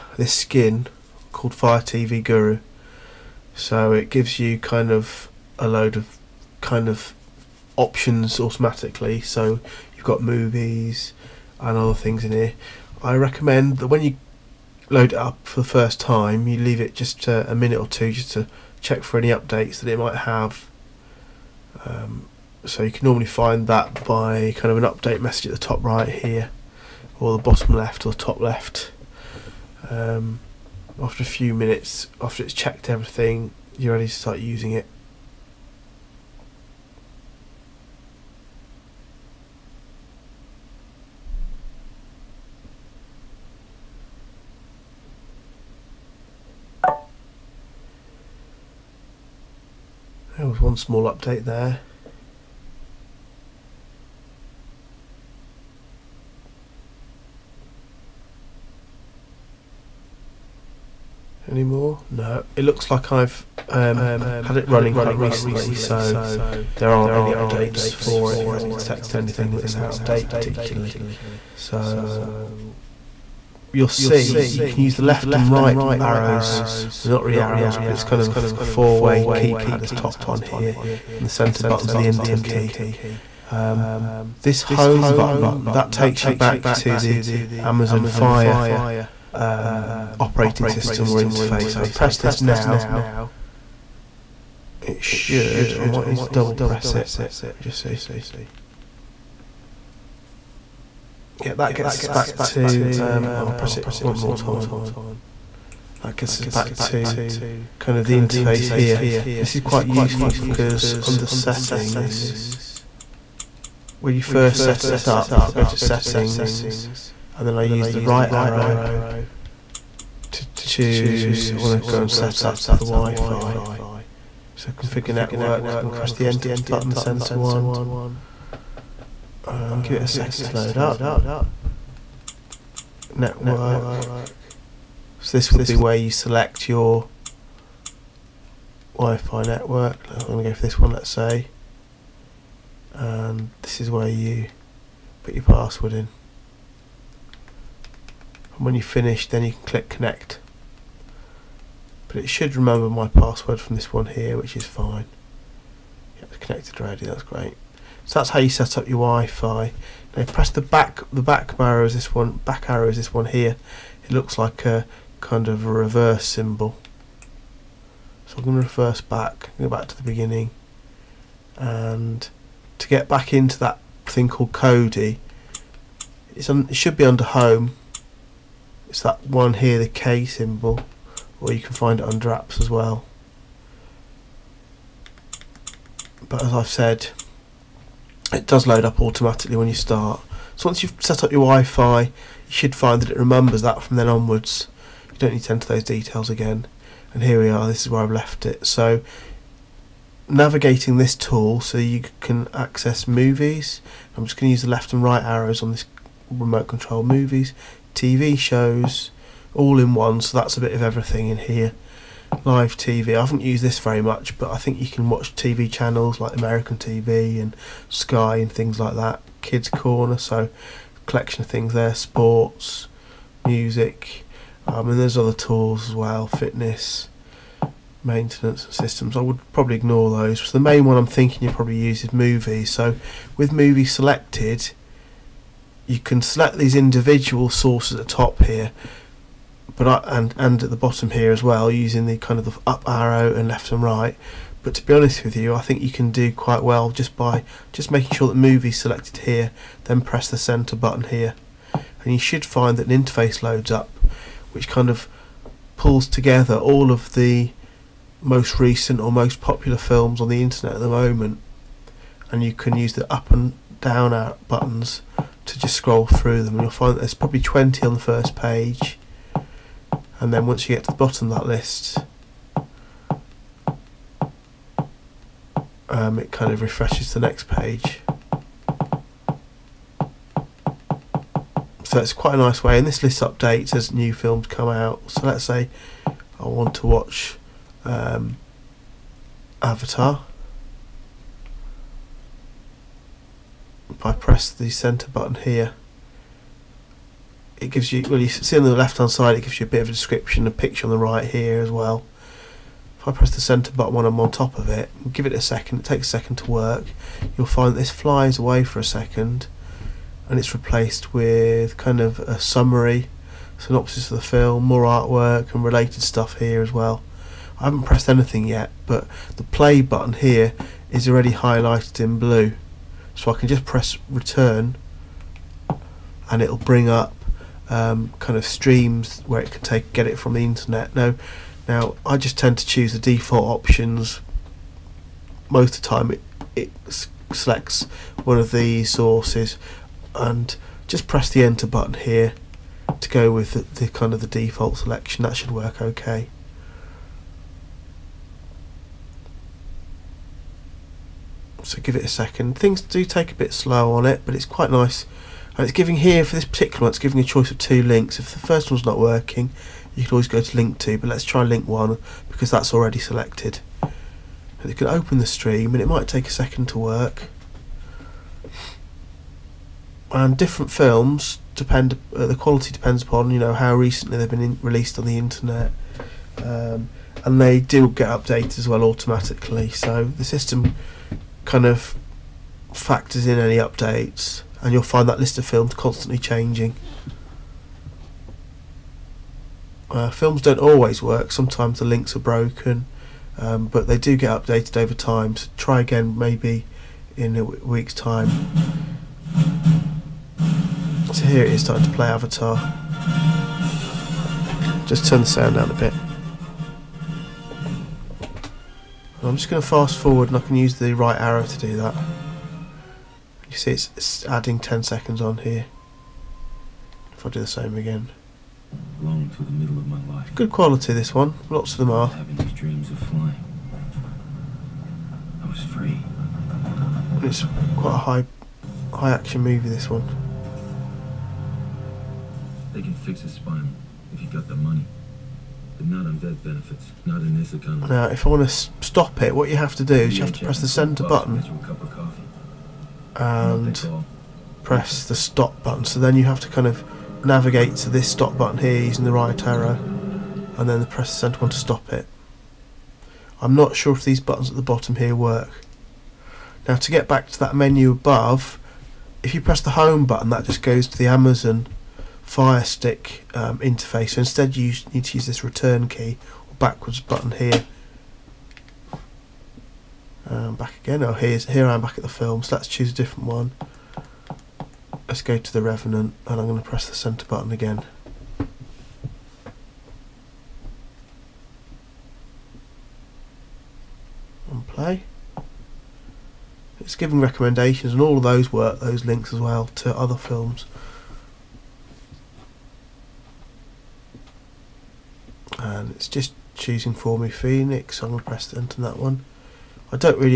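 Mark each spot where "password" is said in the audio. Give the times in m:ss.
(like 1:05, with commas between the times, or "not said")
2:25, 2:33.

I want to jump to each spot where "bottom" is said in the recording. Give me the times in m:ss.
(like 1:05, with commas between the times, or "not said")
0:27, 4:00, 4:30, 7:34.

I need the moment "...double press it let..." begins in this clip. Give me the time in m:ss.
1:36.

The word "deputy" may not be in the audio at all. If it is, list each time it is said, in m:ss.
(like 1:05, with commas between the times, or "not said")
not said.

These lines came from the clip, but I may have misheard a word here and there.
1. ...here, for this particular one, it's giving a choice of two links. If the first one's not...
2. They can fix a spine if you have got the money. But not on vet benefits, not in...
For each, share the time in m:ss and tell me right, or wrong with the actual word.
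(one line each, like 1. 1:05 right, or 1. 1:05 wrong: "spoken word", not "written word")
1. 5:55 right
2. 7:12 right.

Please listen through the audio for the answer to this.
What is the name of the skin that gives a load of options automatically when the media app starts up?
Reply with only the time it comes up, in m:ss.
0:01.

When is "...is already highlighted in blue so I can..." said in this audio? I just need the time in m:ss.
5:20.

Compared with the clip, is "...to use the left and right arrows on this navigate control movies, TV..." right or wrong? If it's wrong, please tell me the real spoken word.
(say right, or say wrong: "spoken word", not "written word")
wrong: "remote", not "navigate".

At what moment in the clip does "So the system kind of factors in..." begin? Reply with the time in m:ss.
6:19.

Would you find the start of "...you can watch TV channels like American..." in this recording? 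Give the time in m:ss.
3:34.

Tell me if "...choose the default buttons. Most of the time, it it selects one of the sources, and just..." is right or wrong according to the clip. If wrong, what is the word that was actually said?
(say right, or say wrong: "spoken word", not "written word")
wrong: "options", not "buttons".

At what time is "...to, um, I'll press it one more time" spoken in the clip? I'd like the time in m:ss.
1:42.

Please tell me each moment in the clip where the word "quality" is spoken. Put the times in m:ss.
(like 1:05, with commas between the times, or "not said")
6:12, 7:00.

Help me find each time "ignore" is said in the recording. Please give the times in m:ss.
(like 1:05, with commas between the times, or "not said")
3:49.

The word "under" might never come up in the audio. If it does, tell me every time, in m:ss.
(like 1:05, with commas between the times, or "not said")
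1:51, 2:57, 3:02.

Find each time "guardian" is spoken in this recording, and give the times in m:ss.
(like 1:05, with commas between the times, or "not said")
not said.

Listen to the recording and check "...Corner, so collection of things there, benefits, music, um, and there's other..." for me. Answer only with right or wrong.
wrong.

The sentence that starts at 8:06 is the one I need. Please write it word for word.
It's giving recommendations, and all of those work.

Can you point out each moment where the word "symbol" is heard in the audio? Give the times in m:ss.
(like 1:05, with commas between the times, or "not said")
2:46, 3:00.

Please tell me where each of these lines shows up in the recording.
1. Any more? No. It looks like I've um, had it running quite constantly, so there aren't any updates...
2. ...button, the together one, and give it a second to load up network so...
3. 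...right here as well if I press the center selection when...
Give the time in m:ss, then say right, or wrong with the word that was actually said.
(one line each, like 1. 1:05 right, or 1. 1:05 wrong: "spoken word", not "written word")
1. 1:01 wrong: "recently", not "constantly"
2. 2:06 wrong: "center", not "together"
3. 5:00 wrong: "button", not "selection".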